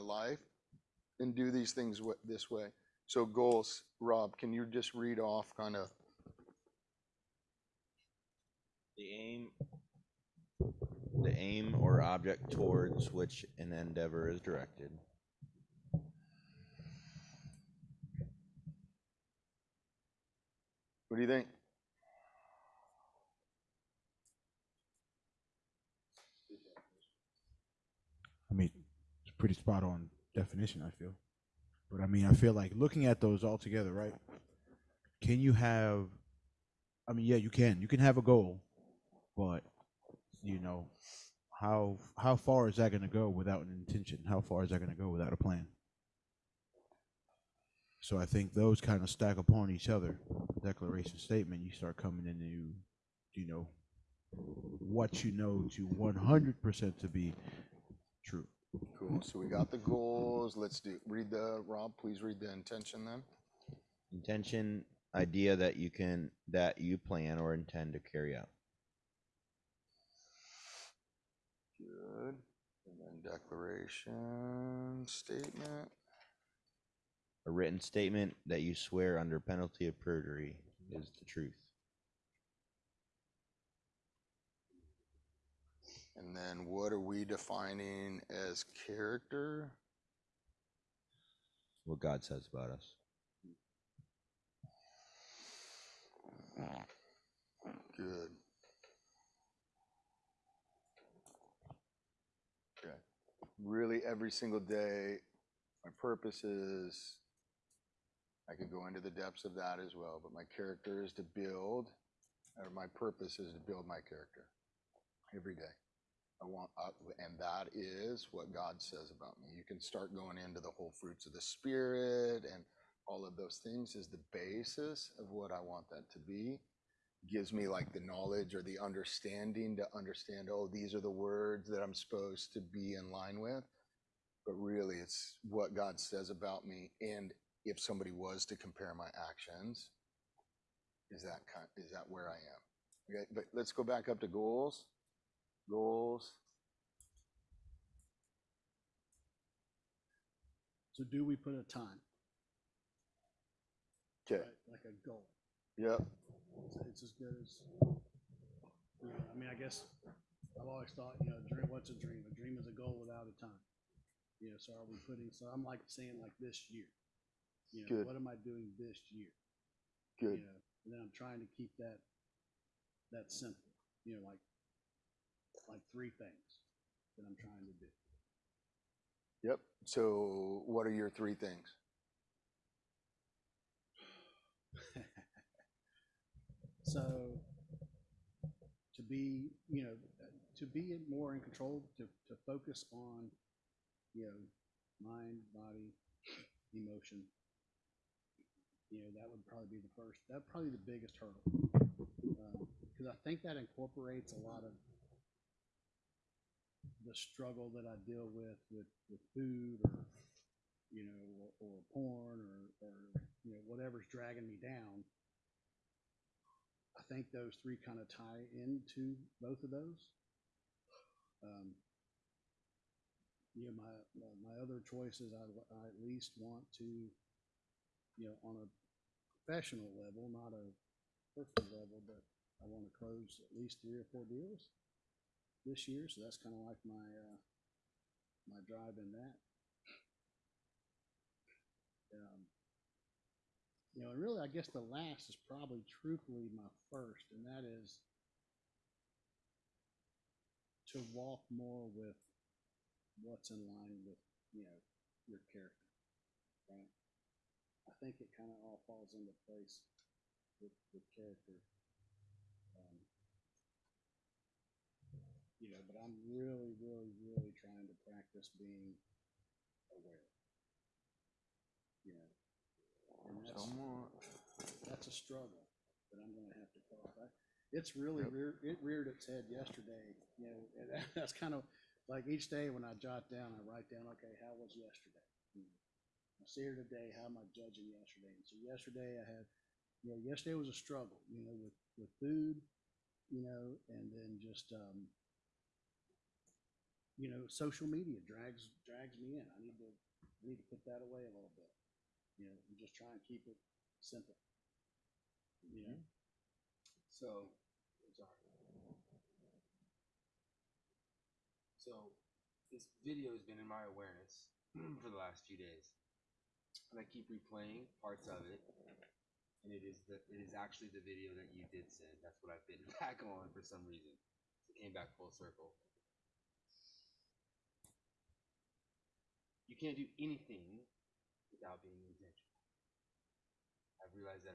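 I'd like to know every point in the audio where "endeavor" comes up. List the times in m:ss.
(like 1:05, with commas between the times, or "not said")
0:13.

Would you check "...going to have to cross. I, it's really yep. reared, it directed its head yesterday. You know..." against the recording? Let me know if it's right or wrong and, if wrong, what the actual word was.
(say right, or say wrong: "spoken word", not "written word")
wrong: "reared", not "directed".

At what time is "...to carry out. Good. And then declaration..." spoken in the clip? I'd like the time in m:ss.
1:07.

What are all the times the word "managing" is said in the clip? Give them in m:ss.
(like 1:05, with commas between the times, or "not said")
not said.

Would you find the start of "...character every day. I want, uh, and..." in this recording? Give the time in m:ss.
1:54.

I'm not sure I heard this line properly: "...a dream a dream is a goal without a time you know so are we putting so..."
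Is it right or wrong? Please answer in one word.
right.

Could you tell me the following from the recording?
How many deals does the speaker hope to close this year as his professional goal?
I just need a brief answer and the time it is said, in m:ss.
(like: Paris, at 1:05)
3 or 4, at 3:53.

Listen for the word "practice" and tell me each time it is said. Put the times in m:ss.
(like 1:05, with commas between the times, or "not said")
4:28.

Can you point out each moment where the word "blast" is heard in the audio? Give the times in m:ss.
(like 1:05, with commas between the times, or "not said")
not said.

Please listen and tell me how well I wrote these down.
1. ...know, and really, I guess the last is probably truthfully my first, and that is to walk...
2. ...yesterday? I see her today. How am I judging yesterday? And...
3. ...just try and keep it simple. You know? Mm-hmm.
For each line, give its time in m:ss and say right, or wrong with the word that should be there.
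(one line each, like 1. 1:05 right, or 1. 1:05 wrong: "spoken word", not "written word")
1. 4:04 right
2. 4:44 right
3. 5:02 right.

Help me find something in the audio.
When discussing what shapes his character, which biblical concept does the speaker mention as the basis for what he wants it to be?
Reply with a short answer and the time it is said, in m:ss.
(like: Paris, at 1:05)
fruits of the Spirit, at 2:00.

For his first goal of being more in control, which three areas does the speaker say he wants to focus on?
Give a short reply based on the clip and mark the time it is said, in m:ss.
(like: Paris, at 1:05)
mind, body, emotion, at 3:15.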